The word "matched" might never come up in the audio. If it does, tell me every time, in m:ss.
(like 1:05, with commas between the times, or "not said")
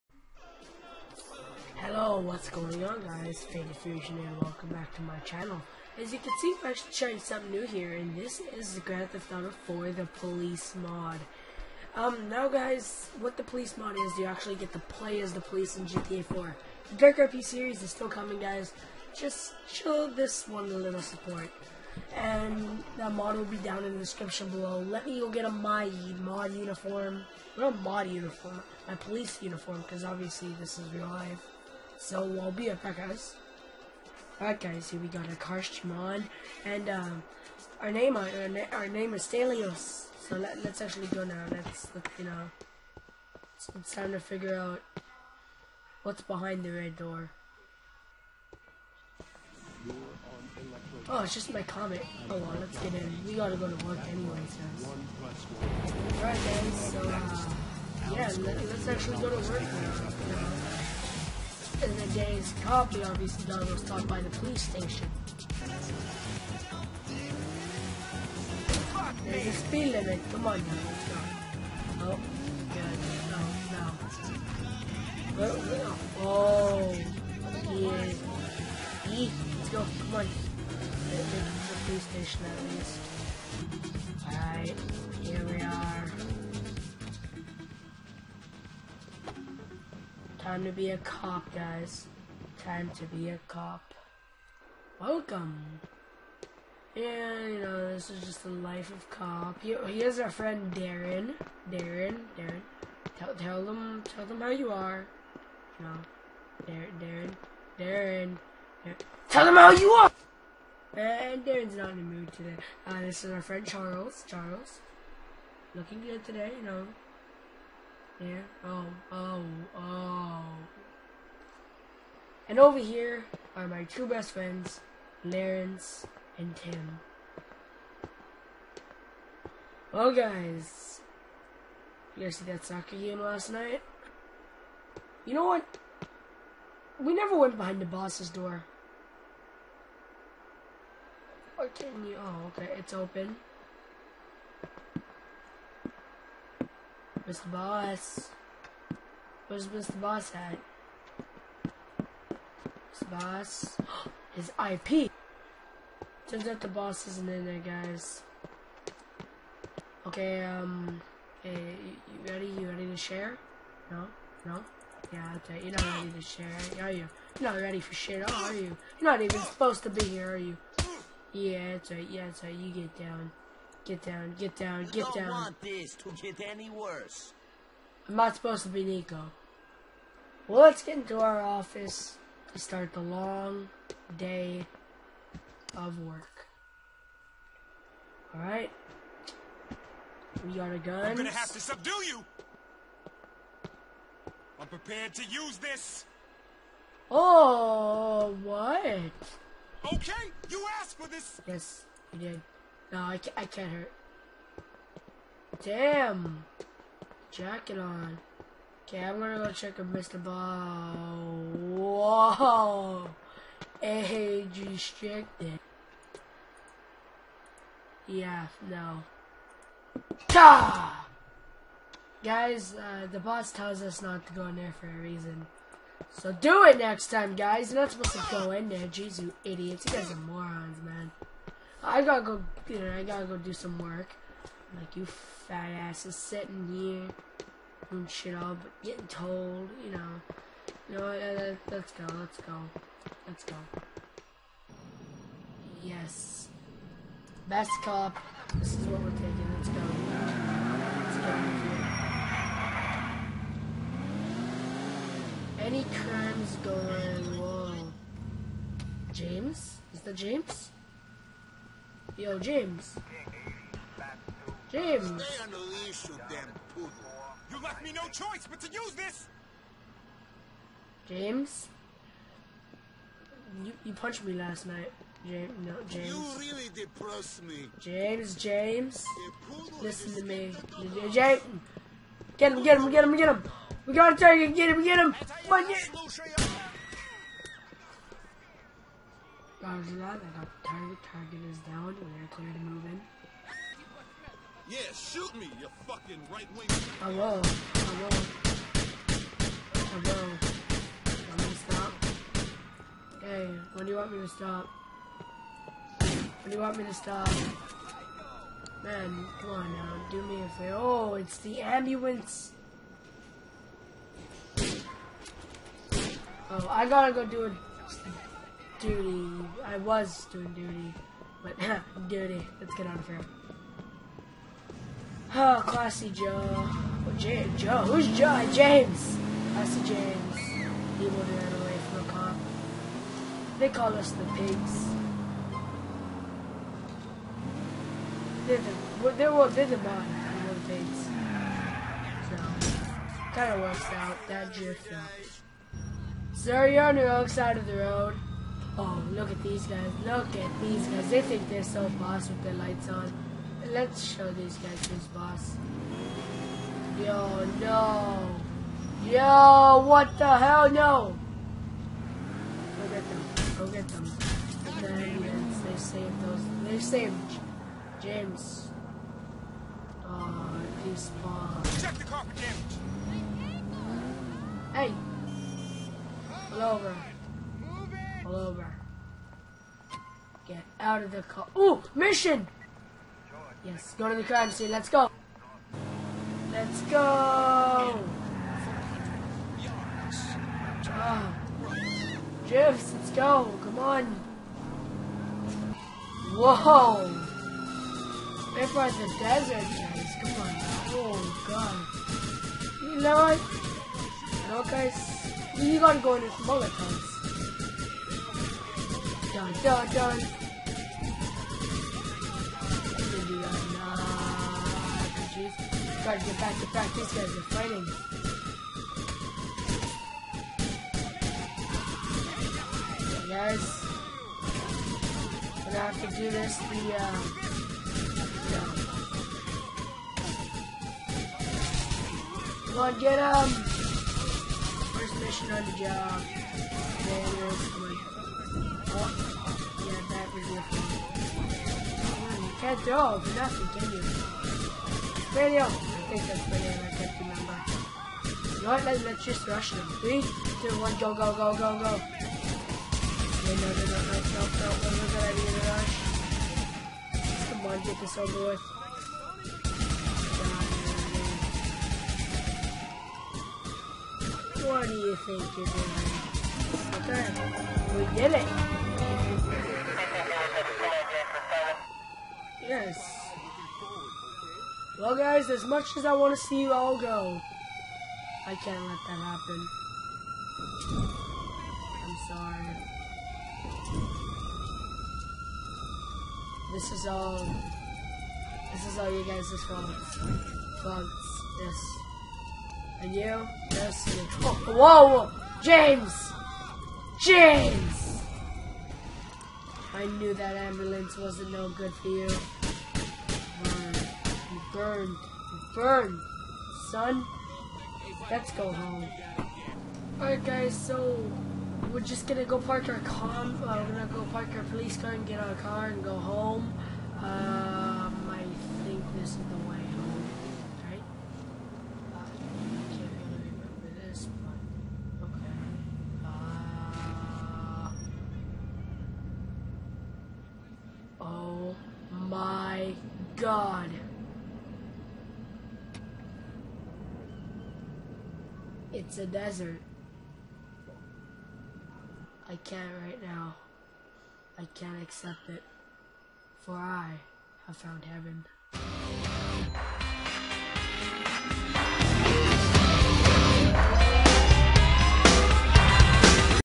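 not said.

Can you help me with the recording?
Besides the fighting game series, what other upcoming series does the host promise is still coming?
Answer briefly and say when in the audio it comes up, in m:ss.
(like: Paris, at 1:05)
Dark RP, at 0:16.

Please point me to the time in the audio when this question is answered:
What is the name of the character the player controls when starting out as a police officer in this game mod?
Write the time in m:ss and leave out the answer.
0:39.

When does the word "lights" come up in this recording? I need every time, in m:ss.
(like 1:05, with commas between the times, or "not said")
5:52.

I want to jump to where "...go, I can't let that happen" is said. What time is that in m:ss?
7:56.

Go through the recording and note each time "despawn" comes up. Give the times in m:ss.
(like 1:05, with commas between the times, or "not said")
6:10.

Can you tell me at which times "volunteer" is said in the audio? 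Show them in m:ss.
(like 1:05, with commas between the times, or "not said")
not said.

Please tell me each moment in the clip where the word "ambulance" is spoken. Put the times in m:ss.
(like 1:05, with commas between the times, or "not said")
5:11, 6:04, 8:20.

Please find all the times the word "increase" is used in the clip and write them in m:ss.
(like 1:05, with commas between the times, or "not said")
not said.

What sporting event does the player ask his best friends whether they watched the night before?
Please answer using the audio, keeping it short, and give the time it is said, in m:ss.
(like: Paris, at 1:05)
soccer game, at 2:12.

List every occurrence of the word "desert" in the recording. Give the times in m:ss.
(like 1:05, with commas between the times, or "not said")
6:39, 8:59.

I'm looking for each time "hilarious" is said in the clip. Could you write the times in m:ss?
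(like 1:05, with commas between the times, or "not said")
not said.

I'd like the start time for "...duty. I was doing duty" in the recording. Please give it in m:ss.
5:18.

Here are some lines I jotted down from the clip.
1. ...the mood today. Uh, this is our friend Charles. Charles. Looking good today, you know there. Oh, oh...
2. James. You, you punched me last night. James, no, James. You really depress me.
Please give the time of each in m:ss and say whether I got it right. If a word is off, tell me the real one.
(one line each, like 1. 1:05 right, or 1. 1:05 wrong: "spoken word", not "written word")
1. 1:51 right
2. 4:31 right.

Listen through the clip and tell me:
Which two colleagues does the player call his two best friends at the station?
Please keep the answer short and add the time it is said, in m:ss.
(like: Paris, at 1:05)
Lawrence and Tim, at 2:05.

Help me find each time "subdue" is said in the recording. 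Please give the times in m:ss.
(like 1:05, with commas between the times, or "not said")
3:11.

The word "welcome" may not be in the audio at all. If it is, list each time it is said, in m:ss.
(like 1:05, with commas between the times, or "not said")
0:04, 1:34.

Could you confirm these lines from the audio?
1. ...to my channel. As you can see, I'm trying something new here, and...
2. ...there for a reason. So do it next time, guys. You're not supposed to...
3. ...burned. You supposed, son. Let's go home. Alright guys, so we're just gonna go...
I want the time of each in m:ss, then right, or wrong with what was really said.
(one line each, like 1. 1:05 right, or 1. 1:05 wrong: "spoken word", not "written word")
1. 0:04 right
2. 3:44 right
3. 8:24 wrong: "burned", not "supposed".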